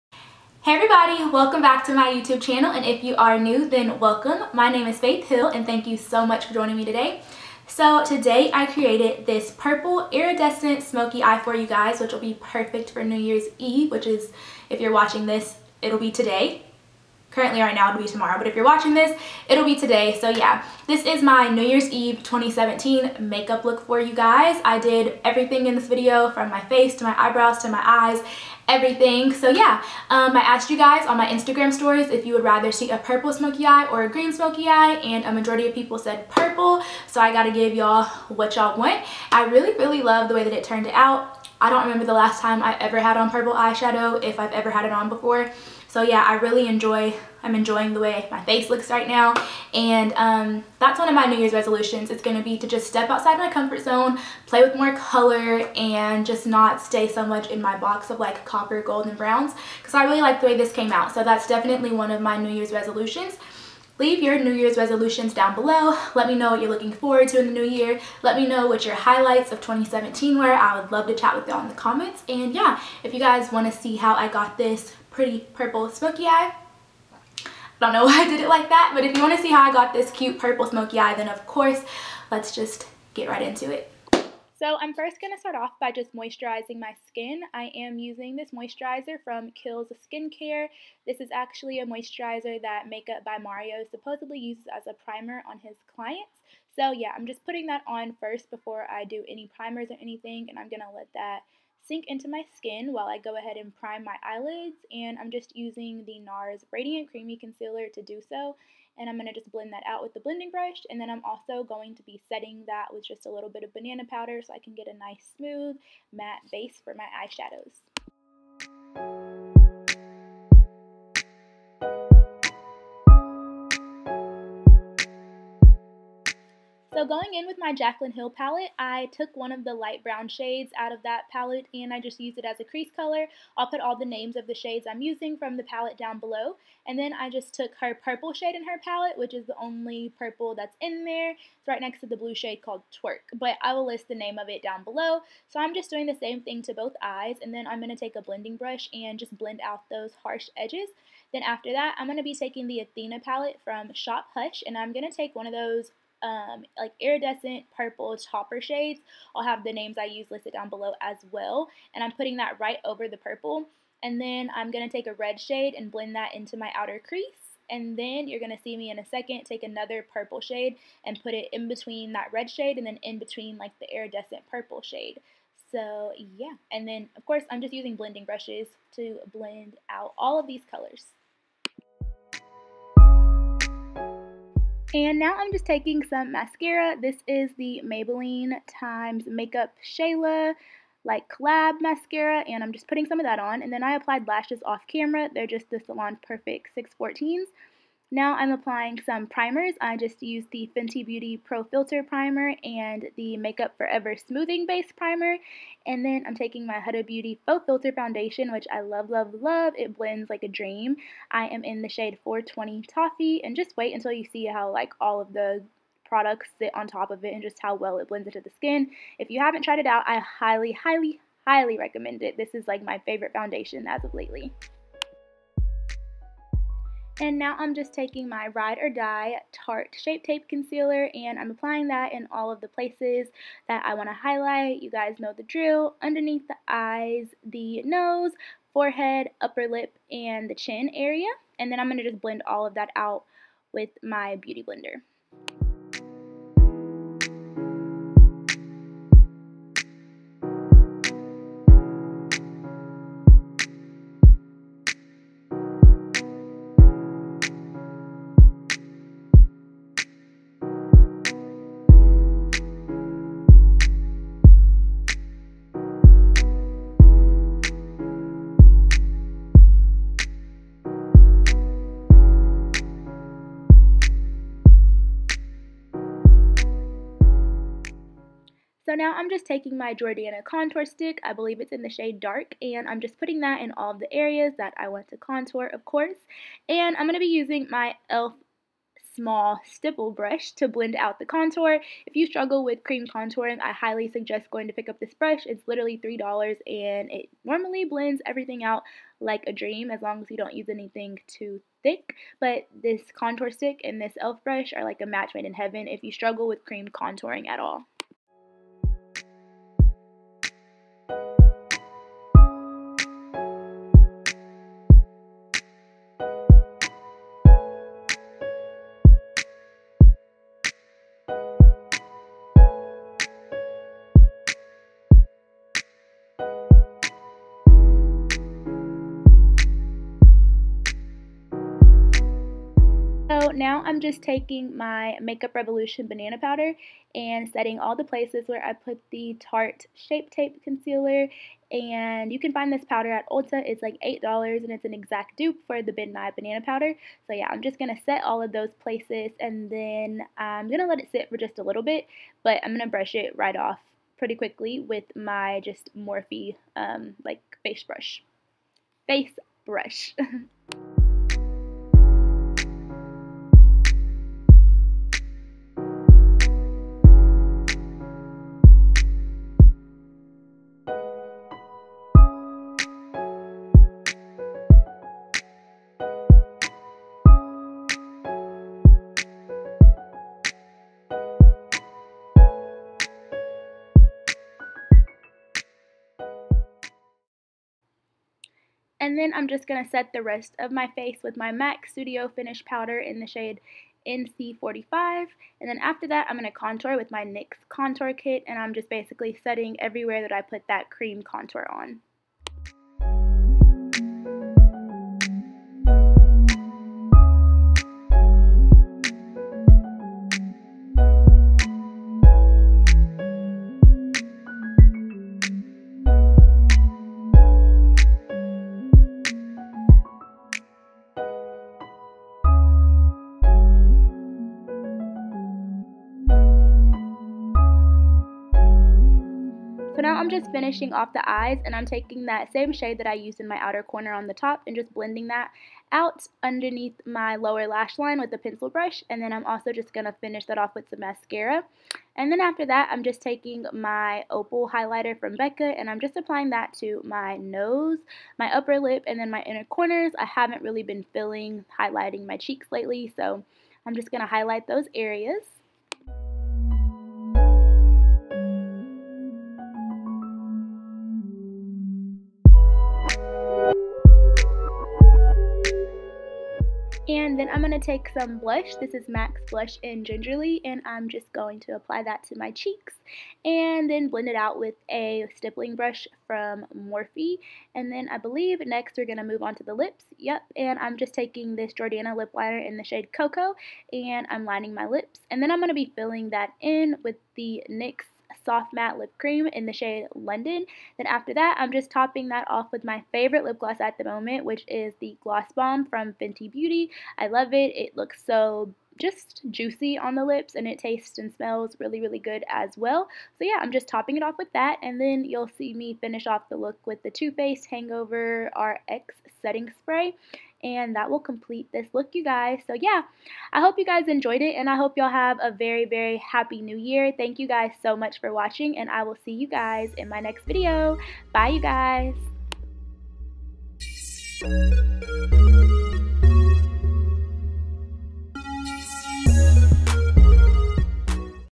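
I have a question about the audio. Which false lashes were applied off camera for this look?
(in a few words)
Salon Perfect 614s.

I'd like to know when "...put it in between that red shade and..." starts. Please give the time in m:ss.
2:51.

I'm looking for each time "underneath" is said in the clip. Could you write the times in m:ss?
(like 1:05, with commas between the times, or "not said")
3:56, 7:16.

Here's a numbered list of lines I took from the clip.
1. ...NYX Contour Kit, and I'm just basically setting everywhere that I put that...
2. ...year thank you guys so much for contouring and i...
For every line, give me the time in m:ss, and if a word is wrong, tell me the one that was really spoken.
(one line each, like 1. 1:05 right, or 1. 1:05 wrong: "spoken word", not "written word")
1. 6:37 right
2. 8:36 wrong: "watching", not "contouring".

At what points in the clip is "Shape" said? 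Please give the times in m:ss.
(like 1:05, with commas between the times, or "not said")
3:49, 5:39.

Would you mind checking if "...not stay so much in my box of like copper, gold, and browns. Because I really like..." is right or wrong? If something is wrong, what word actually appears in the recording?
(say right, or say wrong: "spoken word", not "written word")
right.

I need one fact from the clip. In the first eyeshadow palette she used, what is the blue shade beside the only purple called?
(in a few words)
Twerk.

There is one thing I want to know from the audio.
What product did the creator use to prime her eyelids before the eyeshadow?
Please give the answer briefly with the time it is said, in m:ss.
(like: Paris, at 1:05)
NARS Radiant Creamy Concealer, at 1:46.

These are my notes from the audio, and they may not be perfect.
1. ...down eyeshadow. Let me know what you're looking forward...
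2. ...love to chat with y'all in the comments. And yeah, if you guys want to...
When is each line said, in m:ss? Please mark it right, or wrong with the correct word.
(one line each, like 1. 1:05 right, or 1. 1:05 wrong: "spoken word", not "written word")
1. 1:05 wrong: "below", not "eyeshadow"
2. 1:10 right.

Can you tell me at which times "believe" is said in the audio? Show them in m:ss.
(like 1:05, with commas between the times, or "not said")
4:41, 7:58.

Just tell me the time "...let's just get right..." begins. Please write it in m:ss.
1:22.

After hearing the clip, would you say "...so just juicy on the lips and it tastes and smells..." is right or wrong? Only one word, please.
right.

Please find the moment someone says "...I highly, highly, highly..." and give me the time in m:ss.
3:40.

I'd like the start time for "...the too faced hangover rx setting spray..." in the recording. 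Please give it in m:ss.
8:27.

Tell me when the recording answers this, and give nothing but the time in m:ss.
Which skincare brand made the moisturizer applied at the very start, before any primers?
1:29.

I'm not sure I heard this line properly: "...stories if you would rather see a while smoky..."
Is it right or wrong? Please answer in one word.
wrong.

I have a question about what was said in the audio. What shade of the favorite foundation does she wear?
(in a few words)
420 Toffee.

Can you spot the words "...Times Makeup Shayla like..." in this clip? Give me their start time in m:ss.
3:08.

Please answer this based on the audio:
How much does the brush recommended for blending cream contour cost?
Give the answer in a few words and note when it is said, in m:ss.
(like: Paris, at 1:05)
$3, at 4:56.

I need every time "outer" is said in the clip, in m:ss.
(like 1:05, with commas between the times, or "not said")
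2:46, 7:13.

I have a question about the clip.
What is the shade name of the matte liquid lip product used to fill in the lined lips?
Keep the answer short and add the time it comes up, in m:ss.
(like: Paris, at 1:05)
London, at 8:10.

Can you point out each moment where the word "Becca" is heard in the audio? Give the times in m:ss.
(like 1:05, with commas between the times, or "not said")
7:25.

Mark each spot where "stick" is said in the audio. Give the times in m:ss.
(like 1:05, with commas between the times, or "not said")
4:40, 5:03.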